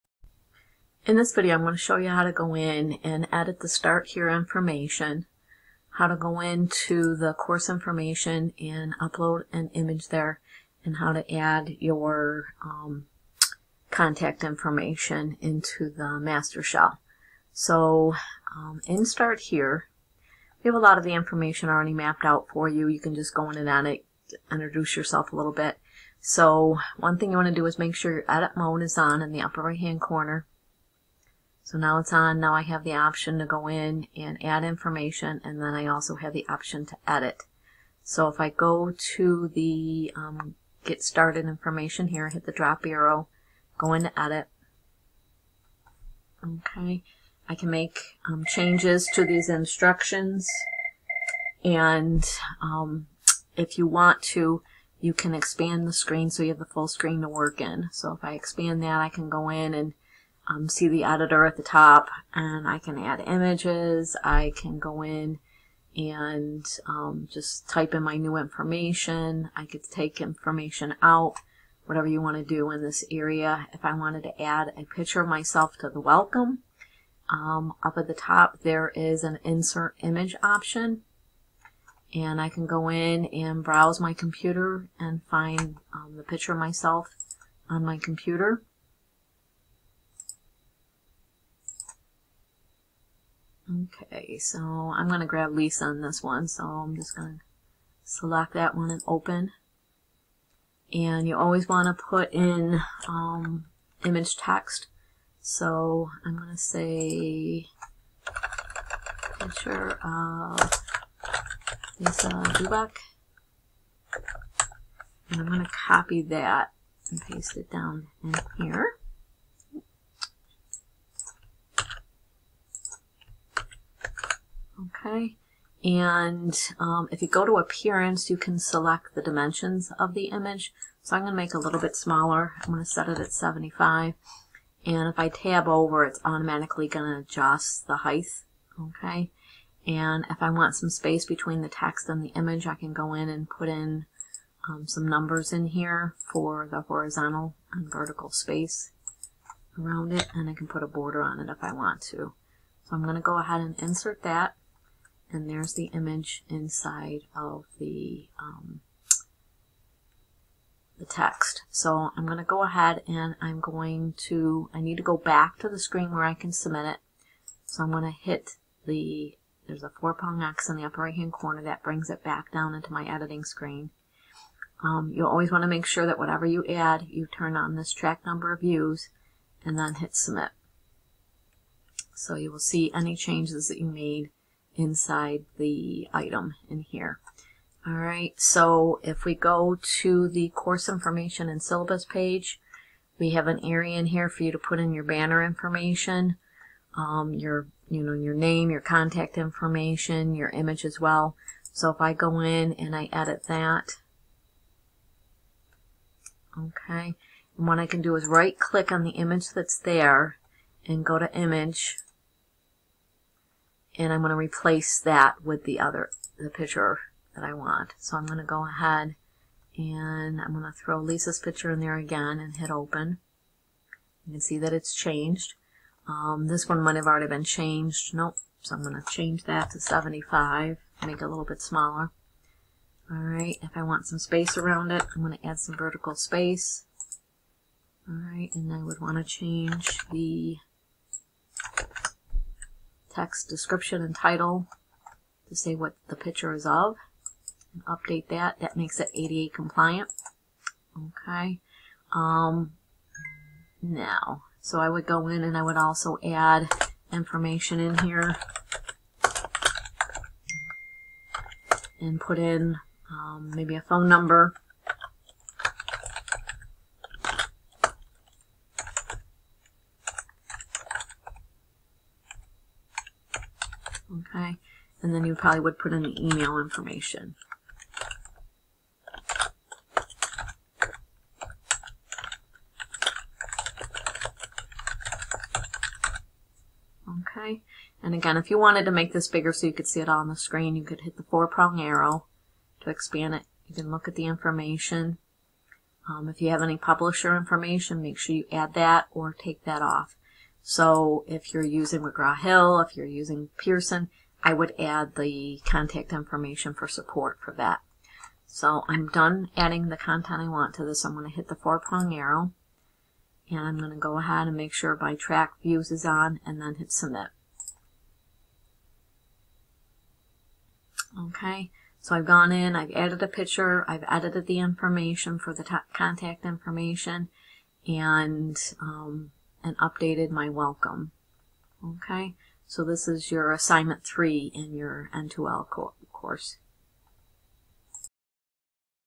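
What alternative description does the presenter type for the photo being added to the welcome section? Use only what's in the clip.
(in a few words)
picture of Lisa Dubak.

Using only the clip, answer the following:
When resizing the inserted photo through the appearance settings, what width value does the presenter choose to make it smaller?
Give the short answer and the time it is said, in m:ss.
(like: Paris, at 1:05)
75, at 2:12.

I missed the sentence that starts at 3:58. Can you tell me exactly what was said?
All right, and I would want to change the text description and title to say what the picture is of.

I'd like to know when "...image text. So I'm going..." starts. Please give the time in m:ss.
1:44.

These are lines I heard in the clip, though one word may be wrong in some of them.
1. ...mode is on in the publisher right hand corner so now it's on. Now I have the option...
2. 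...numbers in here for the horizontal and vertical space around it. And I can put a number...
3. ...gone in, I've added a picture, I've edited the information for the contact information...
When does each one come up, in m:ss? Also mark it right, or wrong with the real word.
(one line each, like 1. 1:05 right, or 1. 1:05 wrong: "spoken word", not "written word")
1. 0:28 wrong: "upper", not "publisher"
2. 2:25 wrong: "border", not "number"
3. 5:22 right.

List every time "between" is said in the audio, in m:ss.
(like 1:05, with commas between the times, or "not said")
2:21.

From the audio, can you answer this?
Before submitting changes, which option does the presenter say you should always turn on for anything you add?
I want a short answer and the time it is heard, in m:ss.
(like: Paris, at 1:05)
track number of views, at 2:57.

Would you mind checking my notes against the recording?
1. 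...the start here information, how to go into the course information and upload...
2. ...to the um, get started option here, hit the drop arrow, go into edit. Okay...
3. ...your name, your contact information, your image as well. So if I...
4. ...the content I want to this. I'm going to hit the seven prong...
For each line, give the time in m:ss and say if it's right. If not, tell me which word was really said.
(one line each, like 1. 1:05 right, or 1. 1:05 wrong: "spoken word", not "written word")
1. 0:03 right
2. 0:39 wrong: "information", not "option"
3. 3:18 right
4. 5:09 wrong: "four", not "seven".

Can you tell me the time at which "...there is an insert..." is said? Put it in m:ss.
1:18.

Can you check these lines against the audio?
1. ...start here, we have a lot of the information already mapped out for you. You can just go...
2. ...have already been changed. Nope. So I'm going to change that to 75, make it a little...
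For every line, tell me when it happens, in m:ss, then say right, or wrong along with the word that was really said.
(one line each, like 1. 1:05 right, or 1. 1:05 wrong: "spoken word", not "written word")
1. 0:19 right
2. 3:46 right.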